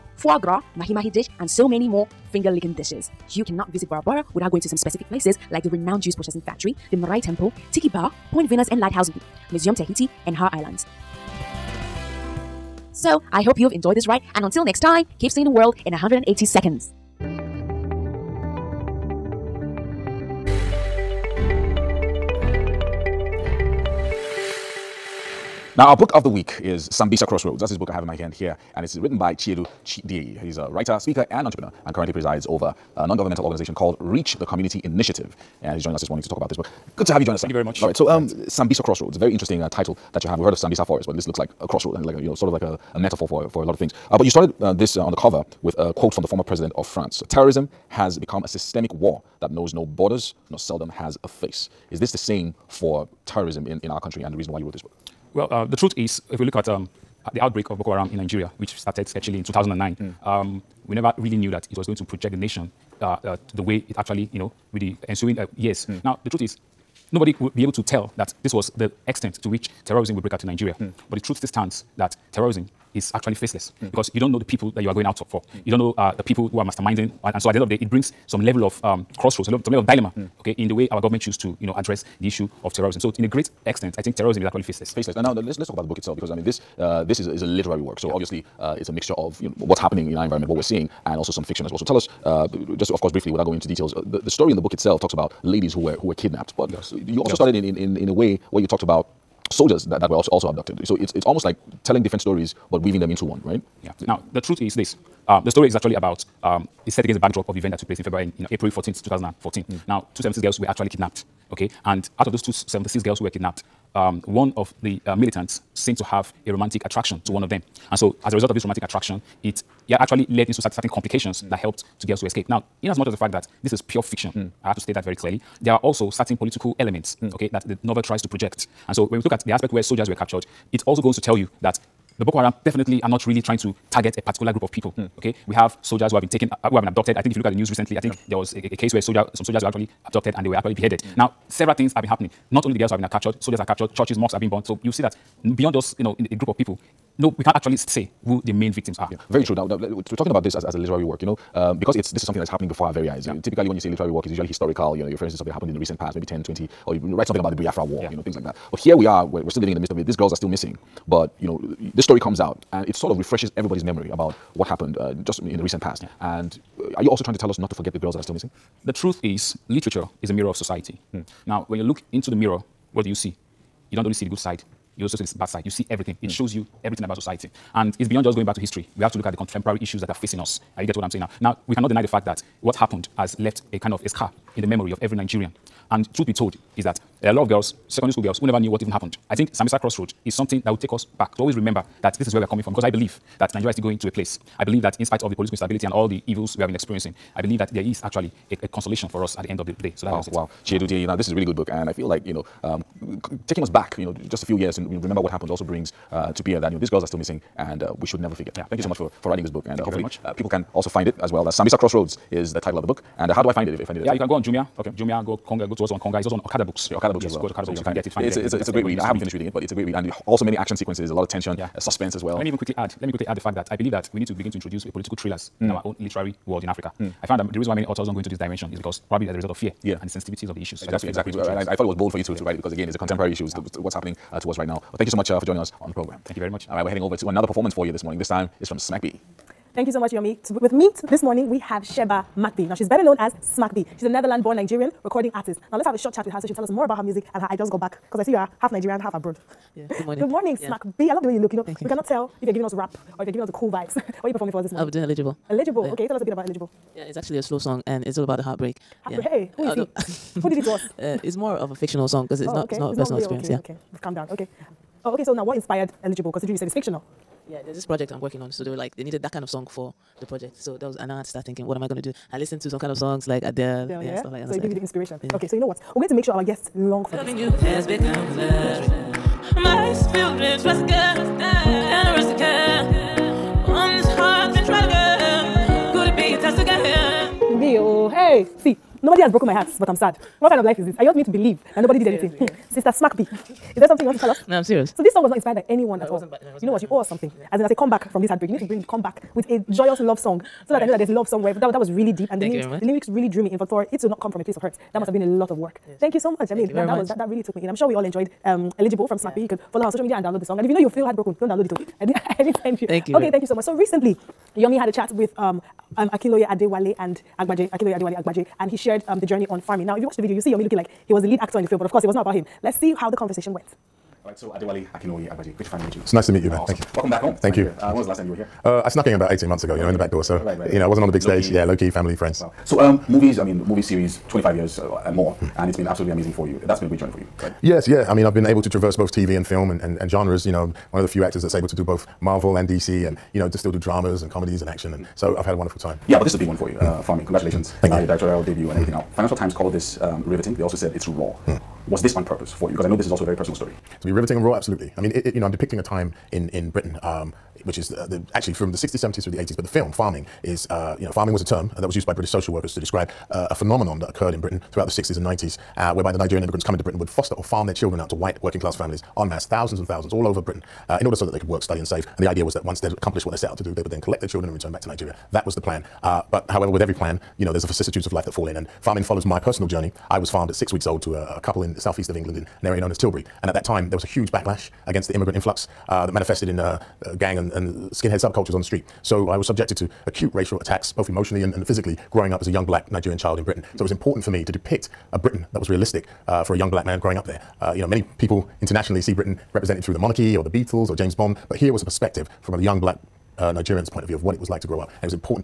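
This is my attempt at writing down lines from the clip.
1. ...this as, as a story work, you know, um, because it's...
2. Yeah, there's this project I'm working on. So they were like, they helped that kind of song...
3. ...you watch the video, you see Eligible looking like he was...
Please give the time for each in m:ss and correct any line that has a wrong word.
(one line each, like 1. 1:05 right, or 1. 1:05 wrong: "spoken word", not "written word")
1. 2:30 wrong: "literary", not "story"
2. 4:27 wrong: "needed", not "helped"
3. 5:20 wrong: "Yomi", not "Eligible".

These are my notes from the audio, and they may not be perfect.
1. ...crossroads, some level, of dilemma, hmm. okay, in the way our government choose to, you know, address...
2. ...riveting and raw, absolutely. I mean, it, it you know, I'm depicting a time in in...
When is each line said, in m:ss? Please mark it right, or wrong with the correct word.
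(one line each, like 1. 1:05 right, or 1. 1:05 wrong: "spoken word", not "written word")
1. 1:19 right
2. 5:54 right.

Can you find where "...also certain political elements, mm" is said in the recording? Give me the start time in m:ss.
2:05.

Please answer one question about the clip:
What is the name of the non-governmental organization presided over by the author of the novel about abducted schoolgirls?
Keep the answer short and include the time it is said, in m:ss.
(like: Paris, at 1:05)
Reach the Community Initiative, at 0:33.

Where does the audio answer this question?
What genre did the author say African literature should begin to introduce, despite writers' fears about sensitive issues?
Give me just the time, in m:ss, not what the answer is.
3:44.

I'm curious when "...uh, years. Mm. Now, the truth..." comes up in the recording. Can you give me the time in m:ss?
1:05.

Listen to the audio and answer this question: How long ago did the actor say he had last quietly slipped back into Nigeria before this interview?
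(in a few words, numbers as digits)
18 months.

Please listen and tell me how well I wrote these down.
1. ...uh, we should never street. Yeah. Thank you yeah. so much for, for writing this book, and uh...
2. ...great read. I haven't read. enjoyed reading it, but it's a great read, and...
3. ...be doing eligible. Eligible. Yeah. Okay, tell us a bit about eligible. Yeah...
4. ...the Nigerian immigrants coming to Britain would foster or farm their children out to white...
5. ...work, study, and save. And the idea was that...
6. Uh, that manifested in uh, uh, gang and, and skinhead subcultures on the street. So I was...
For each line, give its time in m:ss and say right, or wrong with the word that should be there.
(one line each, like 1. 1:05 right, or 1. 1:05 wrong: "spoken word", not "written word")
1. 3:27 wrong: "forget", not "street"
2. 3:38 wrong: "finished", not "enjoyed"
3. 4:14 right
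4. 6:06 right
5. 6:11 right
6. 6:25 right.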